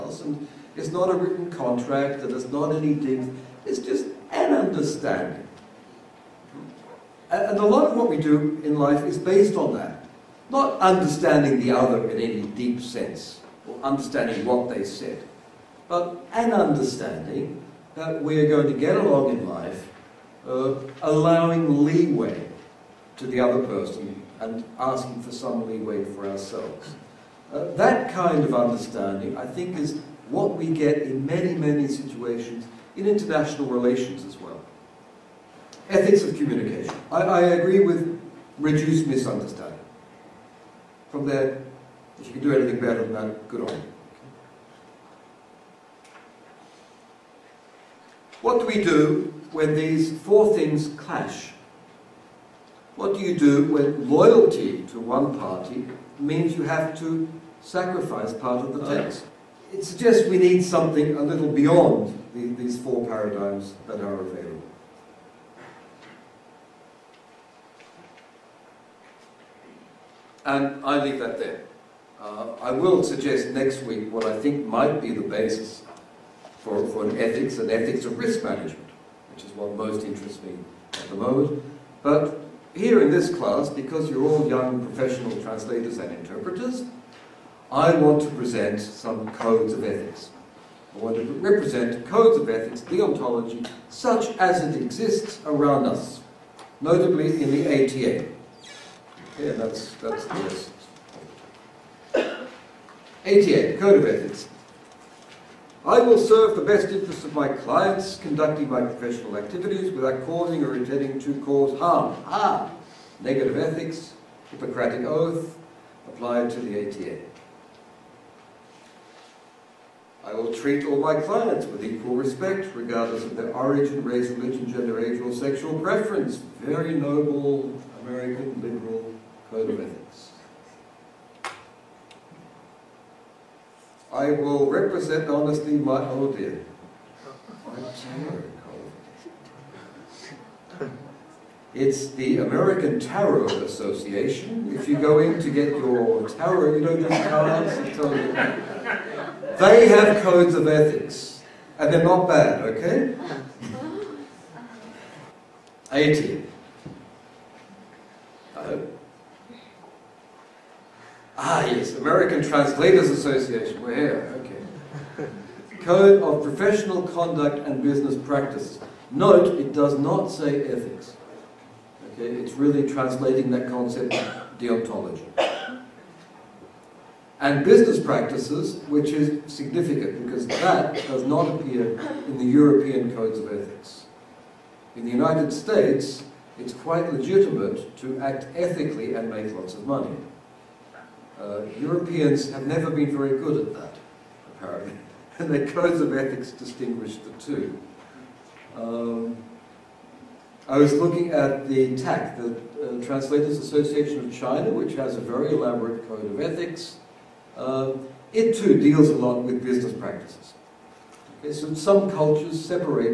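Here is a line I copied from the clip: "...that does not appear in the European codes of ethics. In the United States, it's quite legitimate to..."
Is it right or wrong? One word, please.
right.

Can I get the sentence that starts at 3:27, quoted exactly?
Uh, it too deals a lot with business practices.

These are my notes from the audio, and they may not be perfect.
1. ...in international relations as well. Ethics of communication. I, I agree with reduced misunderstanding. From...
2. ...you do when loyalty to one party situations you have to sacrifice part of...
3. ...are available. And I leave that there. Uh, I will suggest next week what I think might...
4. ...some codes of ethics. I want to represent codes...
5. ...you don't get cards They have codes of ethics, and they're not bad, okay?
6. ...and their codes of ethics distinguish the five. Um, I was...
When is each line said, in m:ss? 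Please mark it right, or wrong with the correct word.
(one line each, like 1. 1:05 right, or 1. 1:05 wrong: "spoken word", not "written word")
1. 0:32 right
2. 0:53 wrong: "means", not "situations"
3. 1:03 right
4. 1:28 right
5. 2:26 right
6. 3:15 wrong: "two", not "five".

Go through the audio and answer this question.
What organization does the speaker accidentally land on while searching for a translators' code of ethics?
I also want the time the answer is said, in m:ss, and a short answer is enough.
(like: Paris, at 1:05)
American Tarot Association, at 2:22.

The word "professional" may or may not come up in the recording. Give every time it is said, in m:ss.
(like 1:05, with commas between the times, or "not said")
1:24, 1:48, 2:46.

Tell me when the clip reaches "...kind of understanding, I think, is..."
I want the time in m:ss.
0:28.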